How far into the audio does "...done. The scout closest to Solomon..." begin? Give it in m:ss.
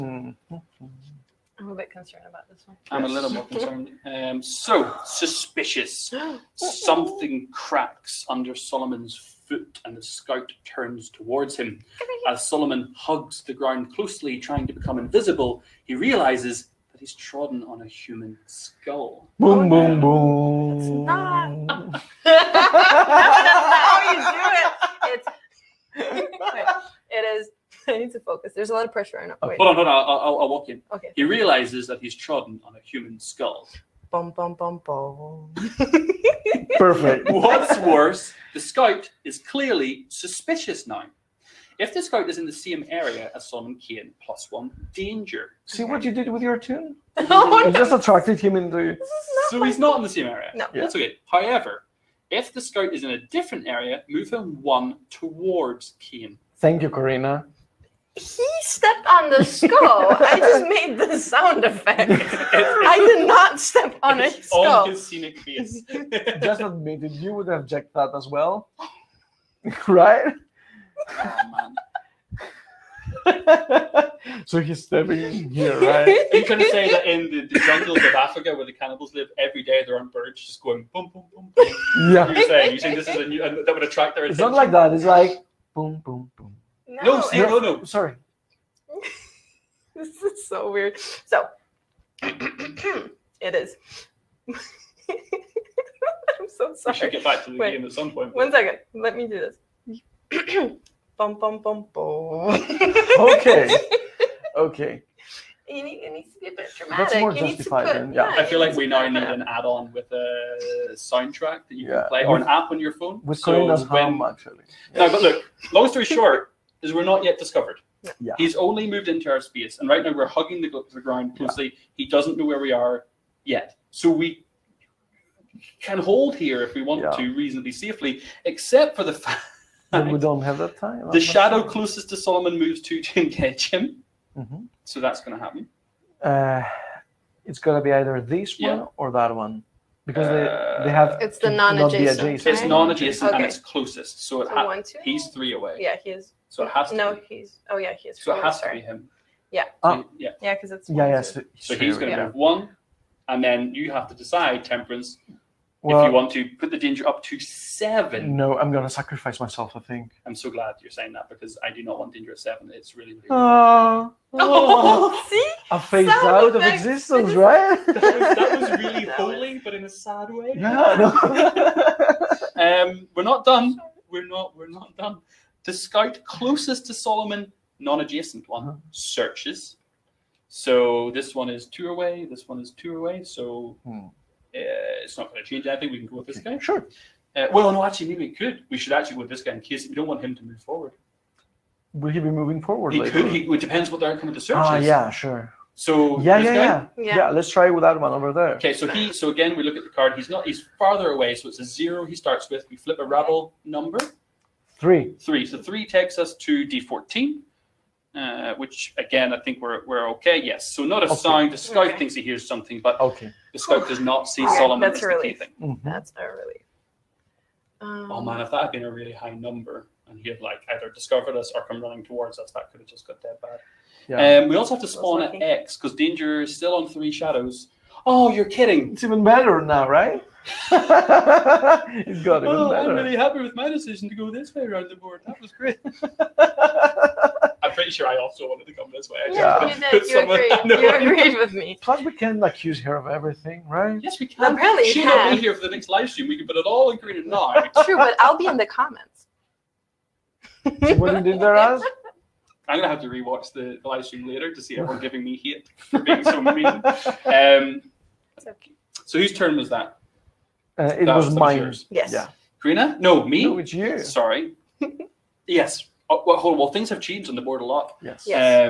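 2:54.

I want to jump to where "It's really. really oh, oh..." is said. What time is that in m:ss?
2:42.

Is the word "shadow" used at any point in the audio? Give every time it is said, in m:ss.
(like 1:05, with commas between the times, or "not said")
2:11, 3:47.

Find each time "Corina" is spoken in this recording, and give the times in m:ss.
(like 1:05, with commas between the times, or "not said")
0:56, 4:22.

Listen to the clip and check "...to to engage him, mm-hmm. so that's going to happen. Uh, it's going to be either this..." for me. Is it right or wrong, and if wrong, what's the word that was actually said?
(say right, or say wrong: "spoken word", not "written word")
right.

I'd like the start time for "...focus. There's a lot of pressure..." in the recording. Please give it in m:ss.
0:28.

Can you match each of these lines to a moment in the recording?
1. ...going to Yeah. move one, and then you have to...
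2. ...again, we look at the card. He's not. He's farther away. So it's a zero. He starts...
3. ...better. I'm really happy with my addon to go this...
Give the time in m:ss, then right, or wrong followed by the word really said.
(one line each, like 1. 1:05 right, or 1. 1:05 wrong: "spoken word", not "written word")
1. 2:31 right
2. 3:19 right
3. 3:52 wrong: "decision", not "addon".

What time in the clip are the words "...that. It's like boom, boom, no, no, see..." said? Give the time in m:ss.
1:24.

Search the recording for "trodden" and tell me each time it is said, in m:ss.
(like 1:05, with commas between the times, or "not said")
0:17, 0:32.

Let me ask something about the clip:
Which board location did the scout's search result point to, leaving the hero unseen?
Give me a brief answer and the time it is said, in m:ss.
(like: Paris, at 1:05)
D14, at 3:26.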